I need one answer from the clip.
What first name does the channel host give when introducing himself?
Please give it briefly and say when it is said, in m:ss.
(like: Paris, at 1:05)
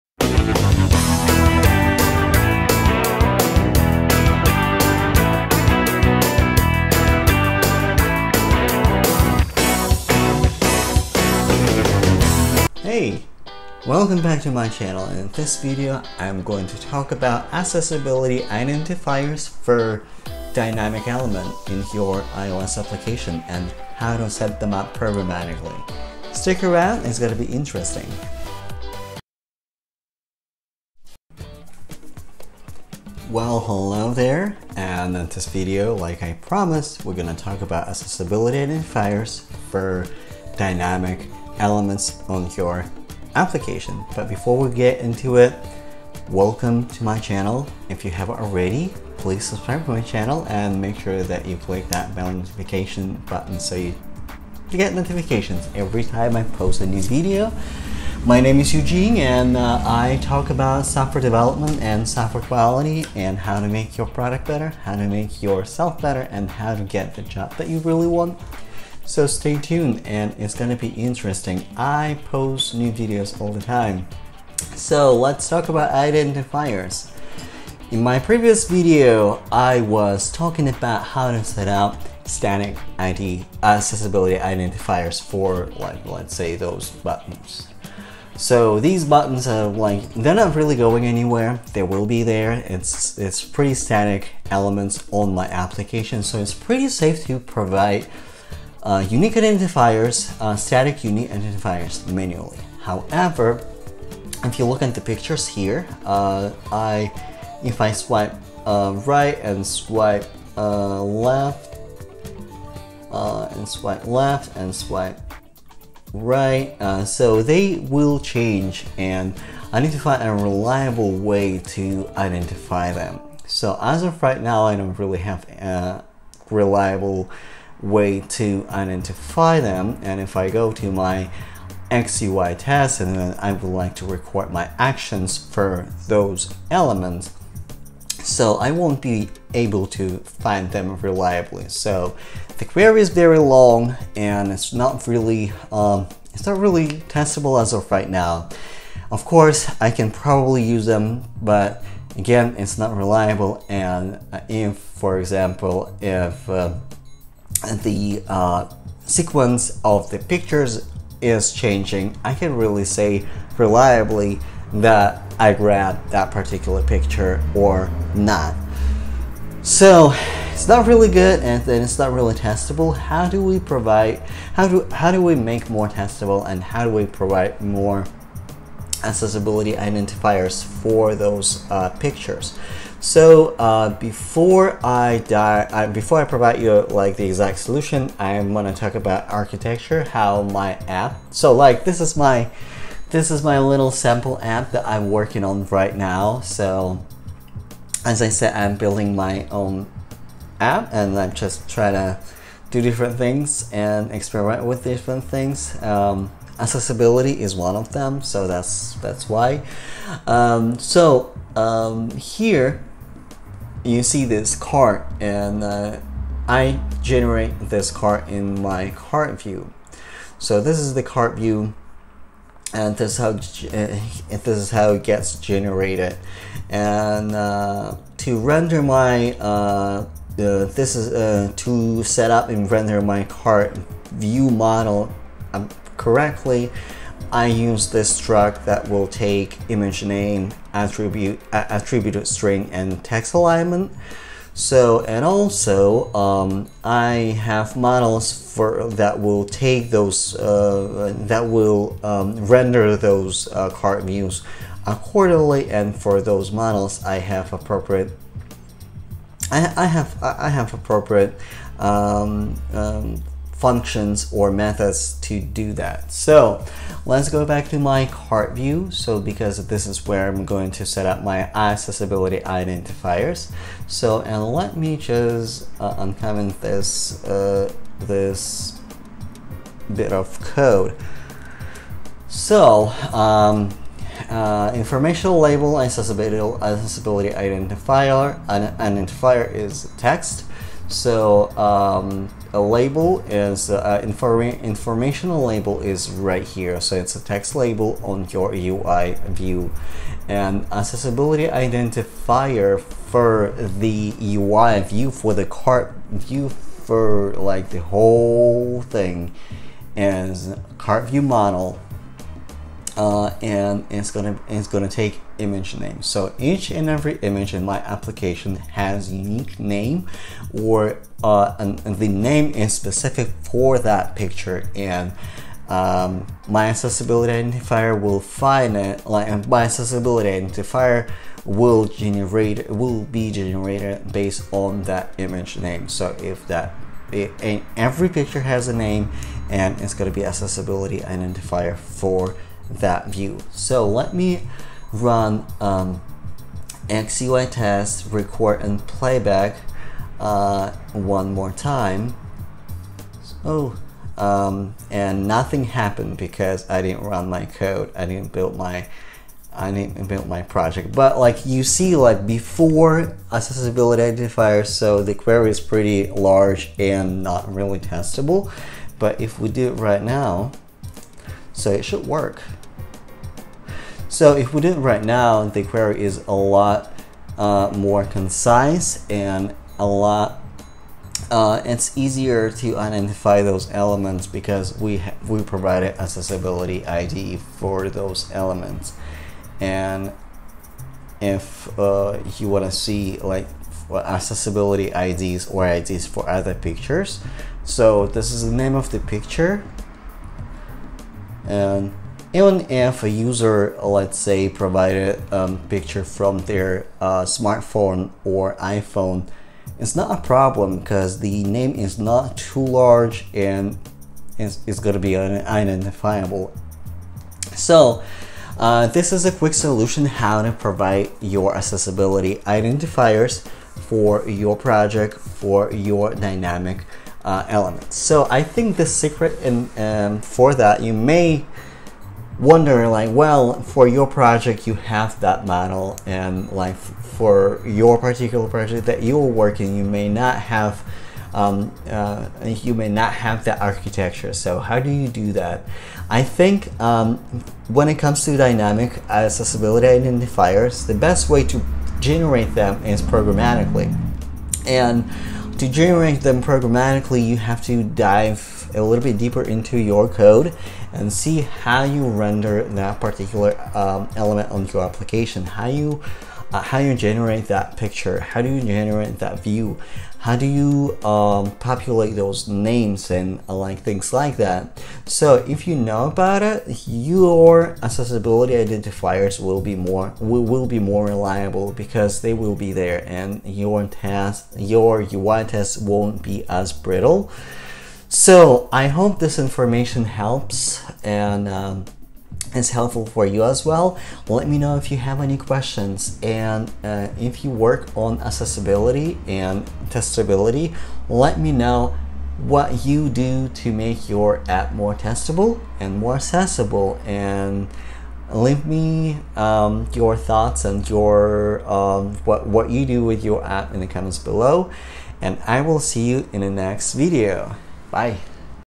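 Eugene, at 0:58.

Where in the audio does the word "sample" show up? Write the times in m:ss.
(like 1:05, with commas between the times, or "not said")
3:13.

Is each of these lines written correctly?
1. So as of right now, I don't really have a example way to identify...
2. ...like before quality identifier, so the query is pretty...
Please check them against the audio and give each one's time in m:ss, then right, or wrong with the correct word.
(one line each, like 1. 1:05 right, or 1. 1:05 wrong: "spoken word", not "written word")
1. 2:03 wrong: "reliable", not "example"
2. 6:01 wrong: "accessibility", not "quality".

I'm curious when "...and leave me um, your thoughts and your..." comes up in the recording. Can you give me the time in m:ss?
8:27.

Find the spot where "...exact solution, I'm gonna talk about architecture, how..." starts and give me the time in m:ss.
3:07.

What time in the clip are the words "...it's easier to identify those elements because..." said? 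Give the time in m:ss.
6:21.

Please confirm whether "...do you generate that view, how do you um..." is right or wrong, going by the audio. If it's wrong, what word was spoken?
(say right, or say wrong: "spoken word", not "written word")
right.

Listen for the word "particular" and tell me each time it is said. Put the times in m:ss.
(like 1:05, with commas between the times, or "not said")
2:46, 7:17, 7:42.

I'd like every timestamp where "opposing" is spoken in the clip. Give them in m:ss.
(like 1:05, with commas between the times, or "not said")
not said.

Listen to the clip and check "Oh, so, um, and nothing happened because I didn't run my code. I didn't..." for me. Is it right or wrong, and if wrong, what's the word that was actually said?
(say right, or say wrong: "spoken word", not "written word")
right.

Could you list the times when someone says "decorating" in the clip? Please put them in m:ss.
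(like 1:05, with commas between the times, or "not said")
not said.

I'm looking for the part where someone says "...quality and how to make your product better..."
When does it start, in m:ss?
1:02.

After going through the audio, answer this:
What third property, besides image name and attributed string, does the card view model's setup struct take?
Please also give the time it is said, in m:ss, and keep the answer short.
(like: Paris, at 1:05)
text alignment, at 4:03.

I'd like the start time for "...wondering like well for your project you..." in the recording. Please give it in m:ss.
7:12.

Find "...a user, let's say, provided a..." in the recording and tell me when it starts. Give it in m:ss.
6:43.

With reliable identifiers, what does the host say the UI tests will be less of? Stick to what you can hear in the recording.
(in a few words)
brittle.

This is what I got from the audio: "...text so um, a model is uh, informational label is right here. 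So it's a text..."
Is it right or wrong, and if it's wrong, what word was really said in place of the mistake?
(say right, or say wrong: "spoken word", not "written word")
wrong: "label", not "model".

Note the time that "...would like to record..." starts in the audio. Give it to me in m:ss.
2:13.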